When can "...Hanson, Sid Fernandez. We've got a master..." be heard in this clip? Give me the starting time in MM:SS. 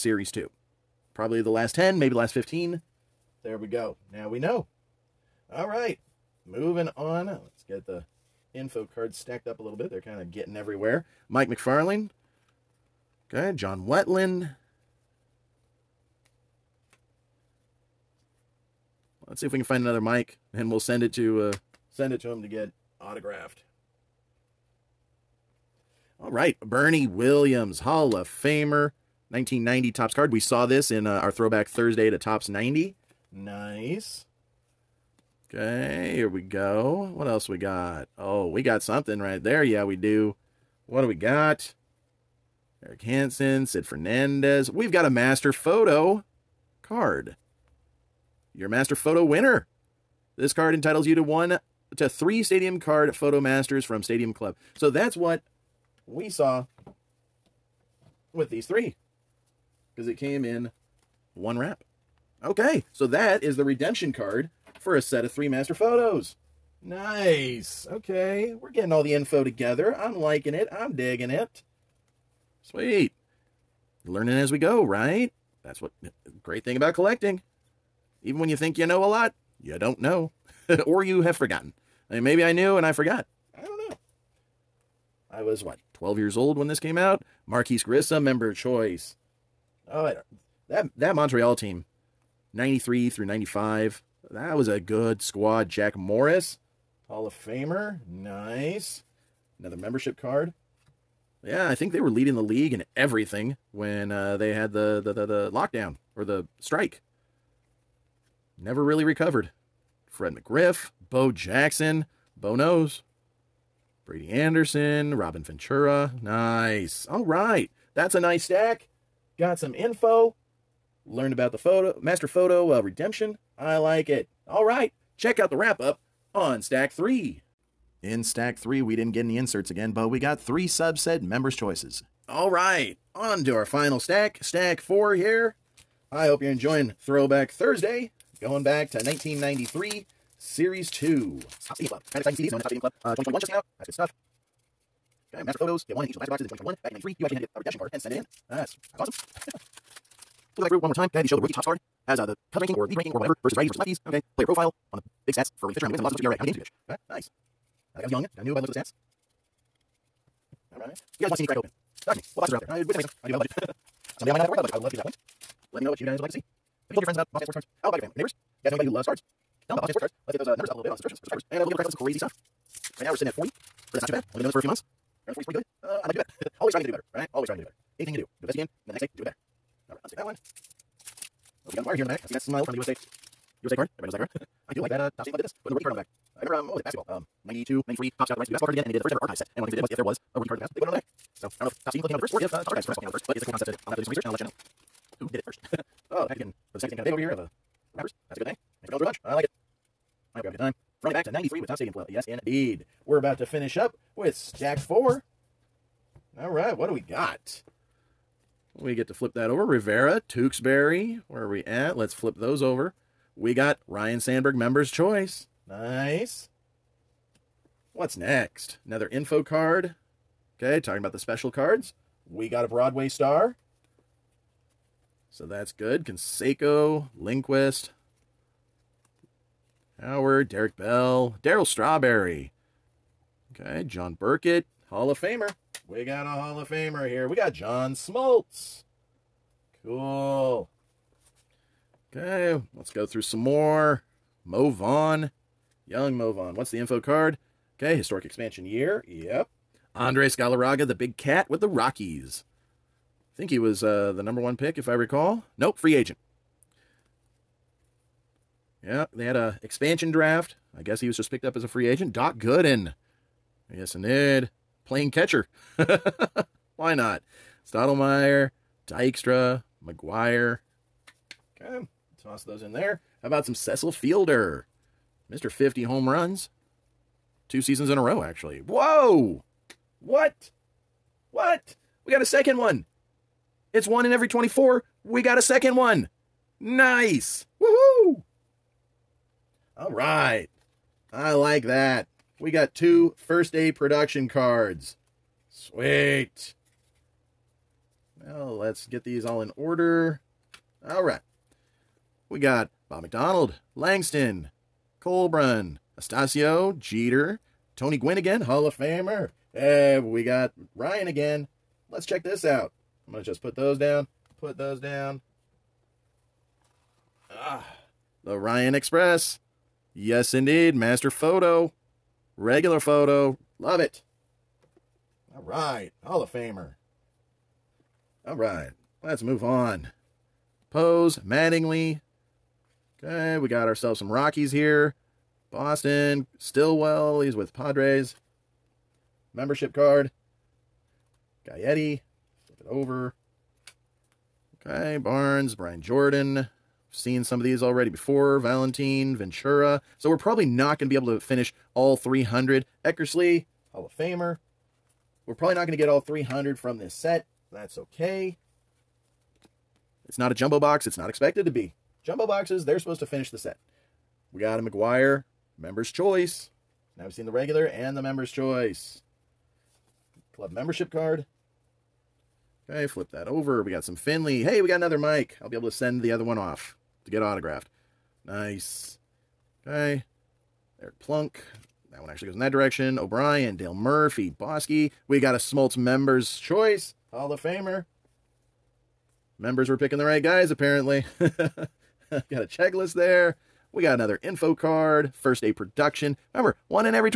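00:42.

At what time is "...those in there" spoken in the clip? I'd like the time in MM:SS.
04:32.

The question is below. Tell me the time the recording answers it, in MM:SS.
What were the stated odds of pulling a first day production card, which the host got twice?
04:43.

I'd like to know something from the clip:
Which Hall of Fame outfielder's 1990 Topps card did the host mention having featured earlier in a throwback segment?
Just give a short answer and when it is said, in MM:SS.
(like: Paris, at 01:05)
Bernie Williams, at 00:26.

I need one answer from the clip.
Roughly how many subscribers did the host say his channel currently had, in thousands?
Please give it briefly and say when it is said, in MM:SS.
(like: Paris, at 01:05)
40, at 02:52.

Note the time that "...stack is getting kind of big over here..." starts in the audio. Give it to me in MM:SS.
03:16.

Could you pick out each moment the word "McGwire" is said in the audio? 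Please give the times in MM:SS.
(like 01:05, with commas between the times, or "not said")
04:29, 06:04.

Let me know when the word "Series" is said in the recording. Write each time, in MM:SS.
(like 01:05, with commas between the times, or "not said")
02:20.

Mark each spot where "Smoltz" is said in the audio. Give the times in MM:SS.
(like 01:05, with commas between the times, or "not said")
03:57, 06:25.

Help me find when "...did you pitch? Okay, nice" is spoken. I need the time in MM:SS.
02:36.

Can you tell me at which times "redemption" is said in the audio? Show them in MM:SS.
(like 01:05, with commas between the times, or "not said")
01:03, 02:02, 02:27.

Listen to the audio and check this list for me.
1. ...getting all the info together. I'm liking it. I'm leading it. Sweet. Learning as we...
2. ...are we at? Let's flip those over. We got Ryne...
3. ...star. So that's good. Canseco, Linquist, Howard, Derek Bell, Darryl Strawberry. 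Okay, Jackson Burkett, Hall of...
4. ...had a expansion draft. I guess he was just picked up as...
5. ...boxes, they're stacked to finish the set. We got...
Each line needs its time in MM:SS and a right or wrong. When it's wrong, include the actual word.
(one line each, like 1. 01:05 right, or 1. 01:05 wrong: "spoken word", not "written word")
1. 01:08 wrong: "digging", not "leading"
2. 03:31 right
3. 03:43 wrong: "John", not "Jackson"
4. 04:19 right
5. 06:02 wrong: "supposed", not "stacked".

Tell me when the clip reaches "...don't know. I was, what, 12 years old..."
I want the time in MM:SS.
01:23.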